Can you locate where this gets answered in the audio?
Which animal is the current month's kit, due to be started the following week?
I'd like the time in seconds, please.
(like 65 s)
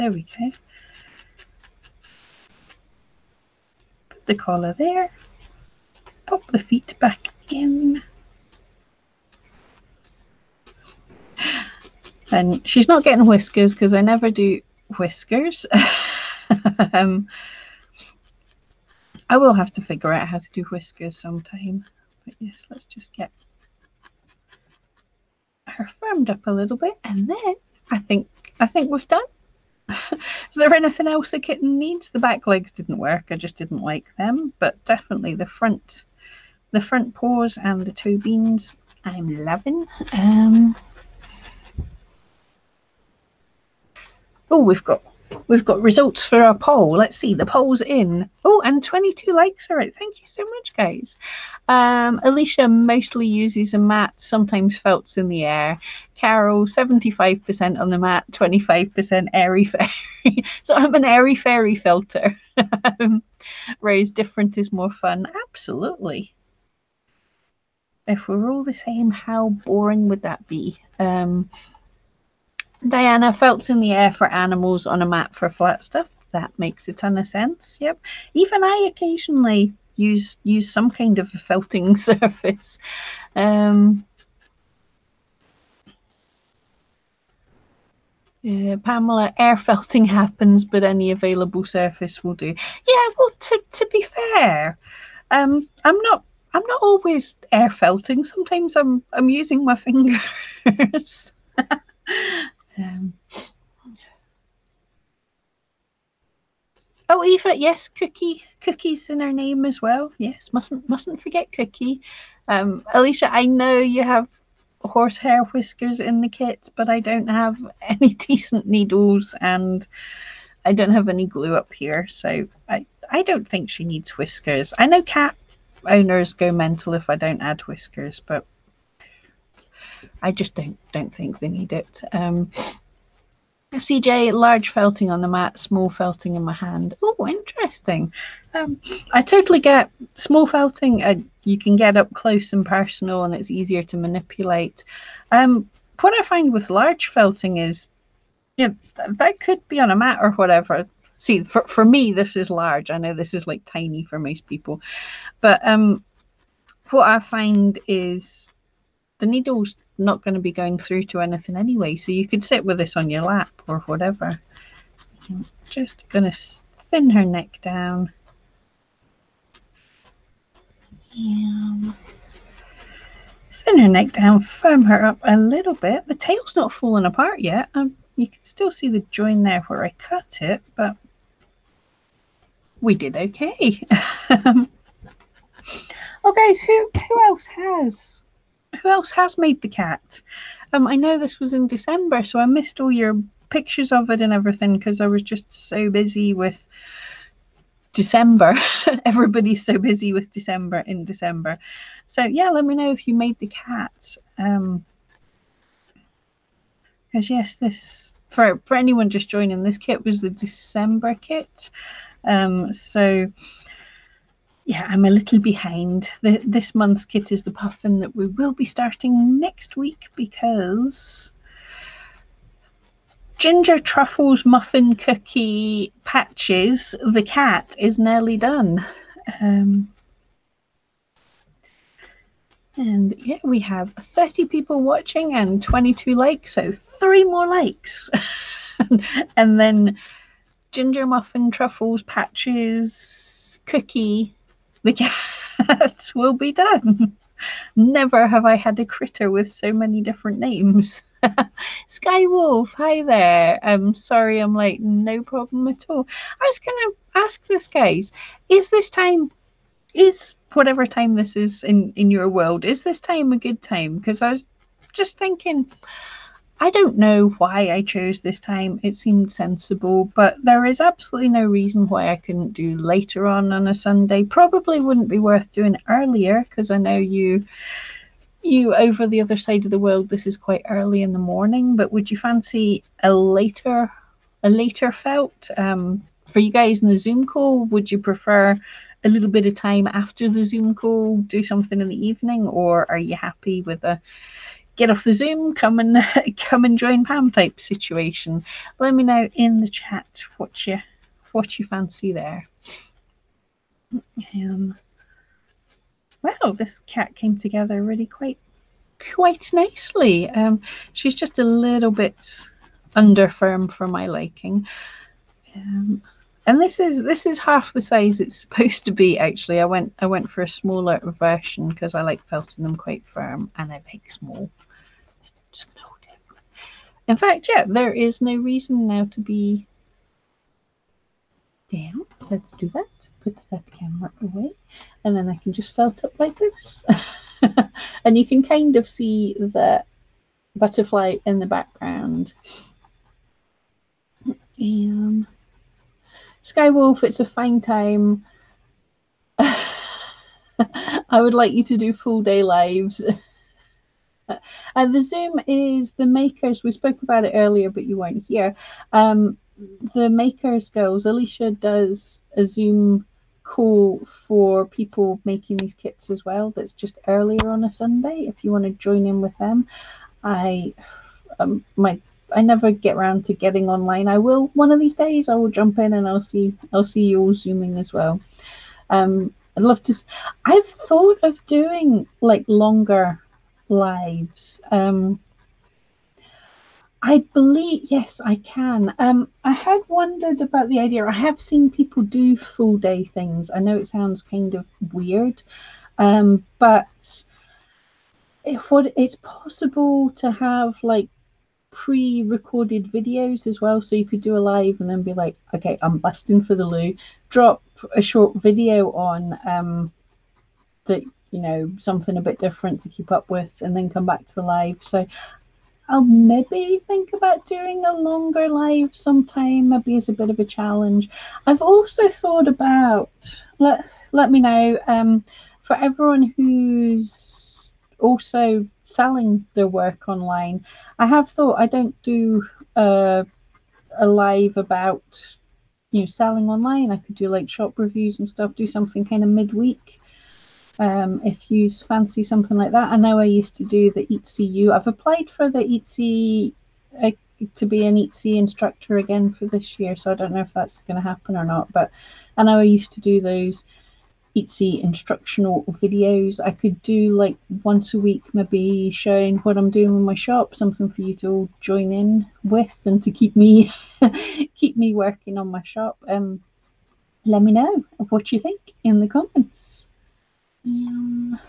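217 s.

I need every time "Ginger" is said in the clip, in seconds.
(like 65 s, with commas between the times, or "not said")
223 s, 240 s.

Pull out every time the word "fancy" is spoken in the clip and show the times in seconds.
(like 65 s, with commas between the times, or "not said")
282 s, 301 s, 441 s.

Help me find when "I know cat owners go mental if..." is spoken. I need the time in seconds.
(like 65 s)
124 s.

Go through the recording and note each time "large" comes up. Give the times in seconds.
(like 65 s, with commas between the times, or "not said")
134 s, 146 s, 152 s.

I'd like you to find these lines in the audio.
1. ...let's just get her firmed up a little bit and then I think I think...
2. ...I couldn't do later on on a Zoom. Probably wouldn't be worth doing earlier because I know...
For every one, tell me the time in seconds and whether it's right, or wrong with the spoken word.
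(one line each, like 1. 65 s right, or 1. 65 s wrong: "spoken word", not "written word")
1. 22 s right
2. 272 s wrong: "Sunday", not "Zoom".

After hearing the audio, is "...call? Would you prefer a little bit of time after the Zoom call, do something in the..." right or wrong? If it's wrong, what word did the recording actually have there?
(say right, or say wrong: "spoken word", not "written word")
right.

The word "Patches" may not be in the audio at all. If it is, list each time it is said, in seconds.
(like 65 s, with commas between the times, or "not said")
226 s, 242 s.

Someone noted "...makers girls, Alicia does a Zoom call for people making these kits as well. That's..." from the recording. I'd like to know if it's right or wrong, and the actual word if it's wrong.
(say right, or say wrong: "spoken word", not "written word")
right.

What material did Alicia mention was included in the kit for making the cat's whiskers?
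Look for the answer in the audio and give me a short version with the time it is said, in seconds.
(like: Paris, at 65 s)
horsehair, at 114 s.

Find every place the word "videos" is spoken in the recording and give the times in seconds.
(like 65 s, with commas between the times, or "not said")
402 s, 408 s, 455 s.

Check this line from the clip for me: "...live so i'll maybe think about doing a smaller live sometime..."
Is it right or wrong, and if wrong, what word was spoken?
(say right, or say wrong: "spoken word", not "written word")
wrong: "longer", not "smaller".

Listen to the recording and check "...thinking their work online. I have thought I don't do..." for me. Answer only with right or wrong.
wrong.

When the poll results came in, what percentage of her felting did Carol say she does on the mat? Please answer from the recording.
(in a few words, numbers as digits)
75%.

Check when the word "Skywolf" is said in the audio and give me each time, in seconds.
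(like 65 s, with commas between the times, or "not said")
251 s, 346 s.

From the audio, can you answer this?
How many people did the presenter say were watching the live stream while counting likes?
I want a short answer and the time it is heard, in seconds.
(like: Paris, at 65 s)
30, at 233 s.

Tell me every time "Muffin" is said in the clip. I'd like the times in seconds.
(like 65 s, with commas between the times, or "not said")
224 s, 241 s.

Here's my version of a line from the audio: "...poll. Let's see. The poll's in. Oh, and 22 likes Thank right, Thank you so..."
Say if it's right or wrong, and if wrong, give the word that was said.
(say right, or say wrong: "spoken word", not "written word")
wrong: "All", not "Thank".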